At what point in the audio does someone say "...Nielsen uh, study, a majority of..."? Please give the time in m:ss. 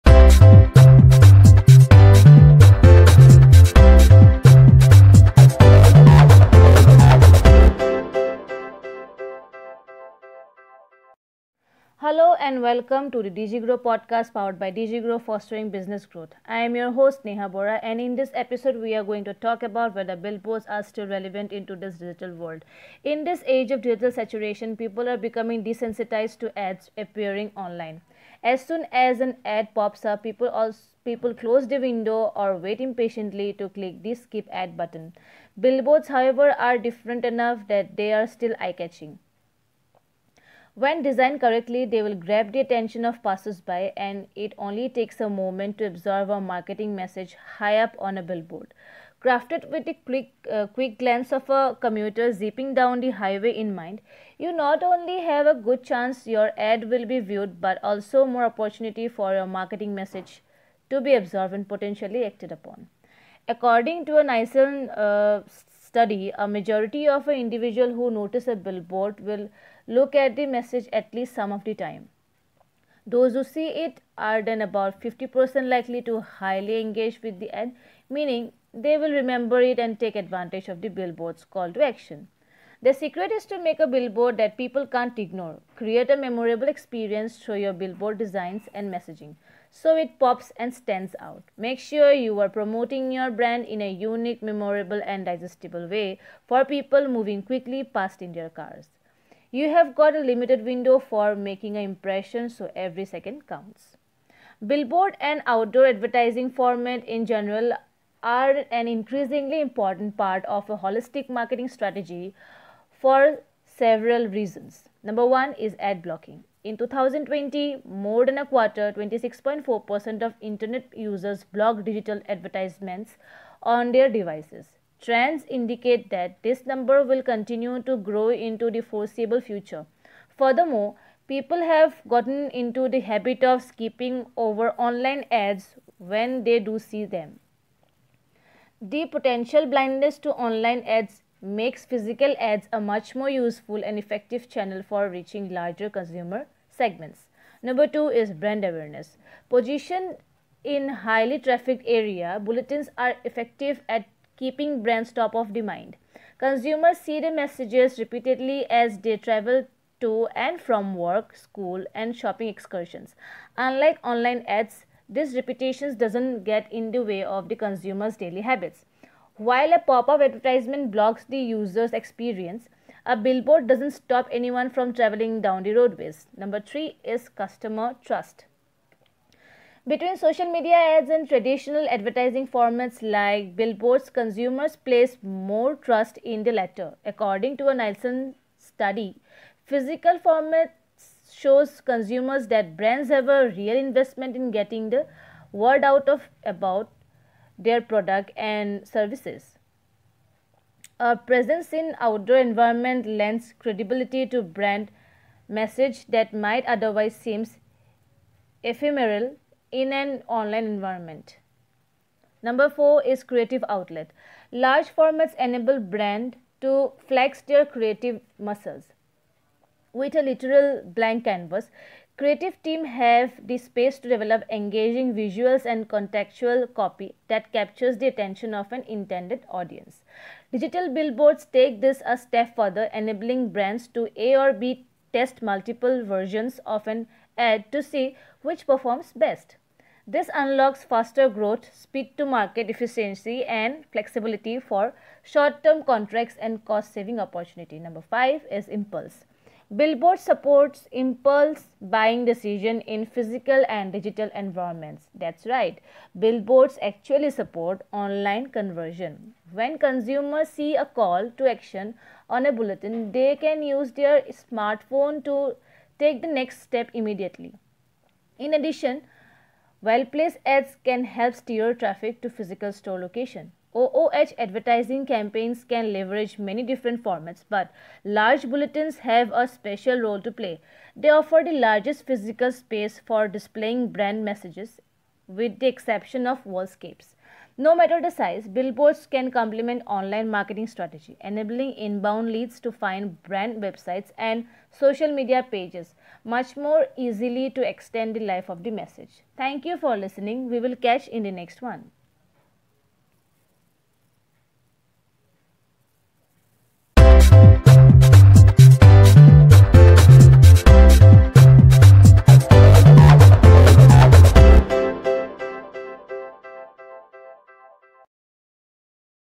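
1:04.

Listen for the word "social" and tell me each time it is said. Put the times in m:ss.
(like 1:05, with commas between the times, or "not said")
3:00, 4:54.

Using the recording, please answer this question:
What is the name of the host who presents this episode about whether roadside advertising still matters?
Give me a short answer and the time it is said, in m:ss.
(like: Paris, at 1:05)
Neha Bora, at 0:17.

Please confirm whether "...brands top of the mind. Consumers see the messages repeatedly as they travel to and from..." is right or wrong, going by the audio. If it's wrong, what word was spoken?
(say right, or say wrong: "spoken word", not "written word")
right.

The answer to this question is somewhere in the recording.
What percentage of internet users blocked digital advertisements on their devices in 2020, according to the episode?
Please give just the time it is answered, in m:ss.
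1:58.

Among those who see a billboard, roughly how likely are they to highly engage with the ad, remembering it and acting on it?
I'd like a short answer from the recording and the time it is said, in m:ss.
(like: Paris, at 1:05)
50%, at 1:15.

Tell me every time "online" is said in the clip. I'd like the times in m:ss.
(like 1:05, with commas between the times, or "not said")
0:27, 2:14, 2:20, 2:44, 3:30, 4:17, 4:49.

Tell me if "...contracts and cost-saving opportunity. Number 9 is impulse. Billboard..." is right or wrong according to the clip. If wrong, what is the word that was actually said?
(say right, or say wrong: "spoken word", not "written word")
wrong: "5", not "9".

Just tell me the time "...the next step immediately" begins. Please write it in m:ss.
4:26.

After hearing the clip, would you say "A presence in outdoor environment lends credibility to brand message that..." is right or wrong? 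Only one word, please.
right.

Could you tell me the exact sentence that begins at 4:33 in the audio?
OOH advertising campaigns can leverage many different formats, but large bulletins have a special role to play.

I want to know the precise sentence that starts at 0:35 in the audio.
Billboards, however, are different enough that they are still eye-catching.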